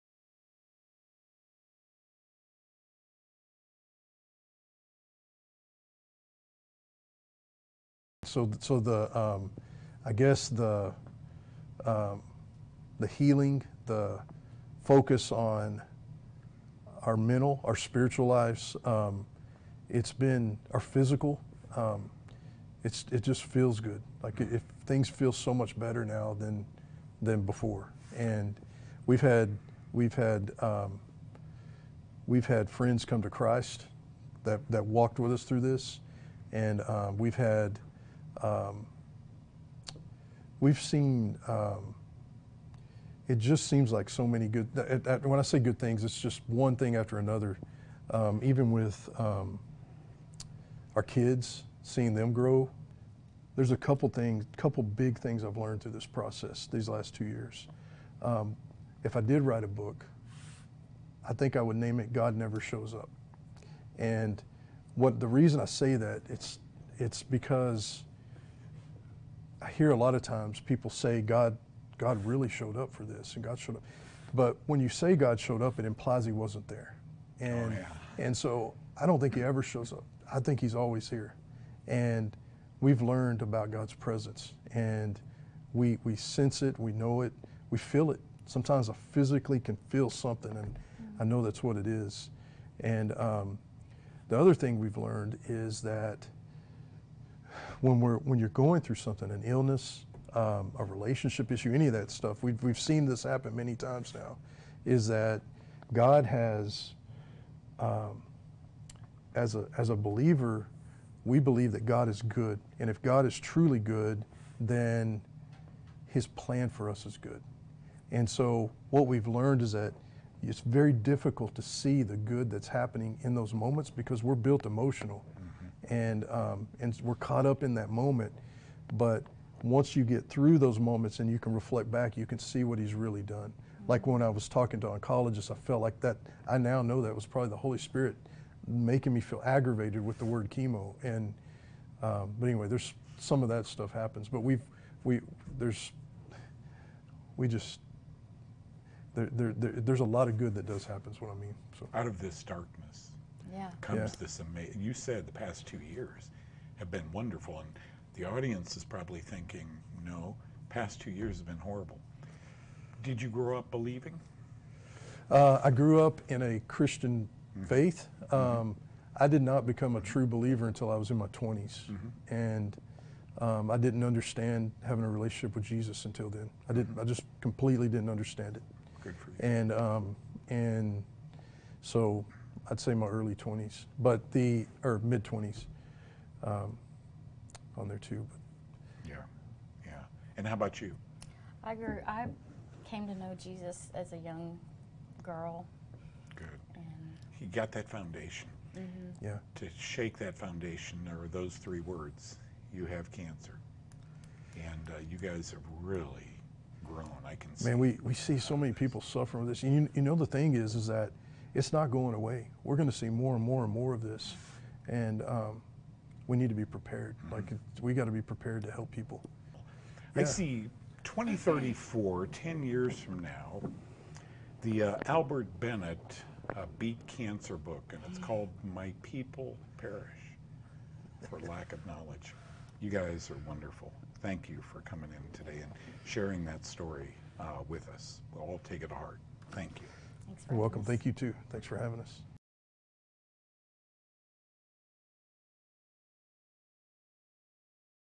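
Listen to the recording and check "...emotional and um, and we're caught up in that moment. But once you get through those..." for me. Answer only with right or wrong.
right.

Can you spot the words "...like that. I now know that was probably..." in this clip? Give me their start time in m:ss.
2:15.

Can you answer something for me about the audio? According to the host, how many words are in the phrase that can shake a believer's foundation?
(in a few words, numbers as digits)
3.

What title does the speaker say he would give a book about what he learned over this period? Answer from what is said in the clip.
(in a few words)
God Never Shows Up.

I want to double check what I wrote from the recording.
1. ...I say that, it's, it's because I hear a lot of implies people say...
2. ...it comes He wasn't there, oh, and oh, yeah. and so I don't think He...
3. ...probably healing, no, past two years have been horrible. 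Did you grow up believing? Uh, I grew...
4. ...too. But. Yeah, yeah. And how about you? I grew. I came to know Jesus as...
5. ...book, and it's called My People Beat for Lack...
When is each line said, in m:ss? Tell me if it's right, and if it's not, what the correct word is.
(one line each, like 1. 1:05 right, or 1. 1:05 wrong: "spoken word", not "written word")
1. 1:05 wrong: "times", not "implies"
2. 1:15 wrong: "implies", not "comes"
3. 2:38 wrong: "thinking", not "healing"
4. 3:07 right
5. 3:47 wrong: "Perish", not "Beat".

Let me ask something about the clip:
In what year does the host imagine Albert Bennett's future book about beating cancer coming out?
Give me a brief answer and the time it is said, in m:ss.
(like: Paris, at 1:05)
2034, at 3:41.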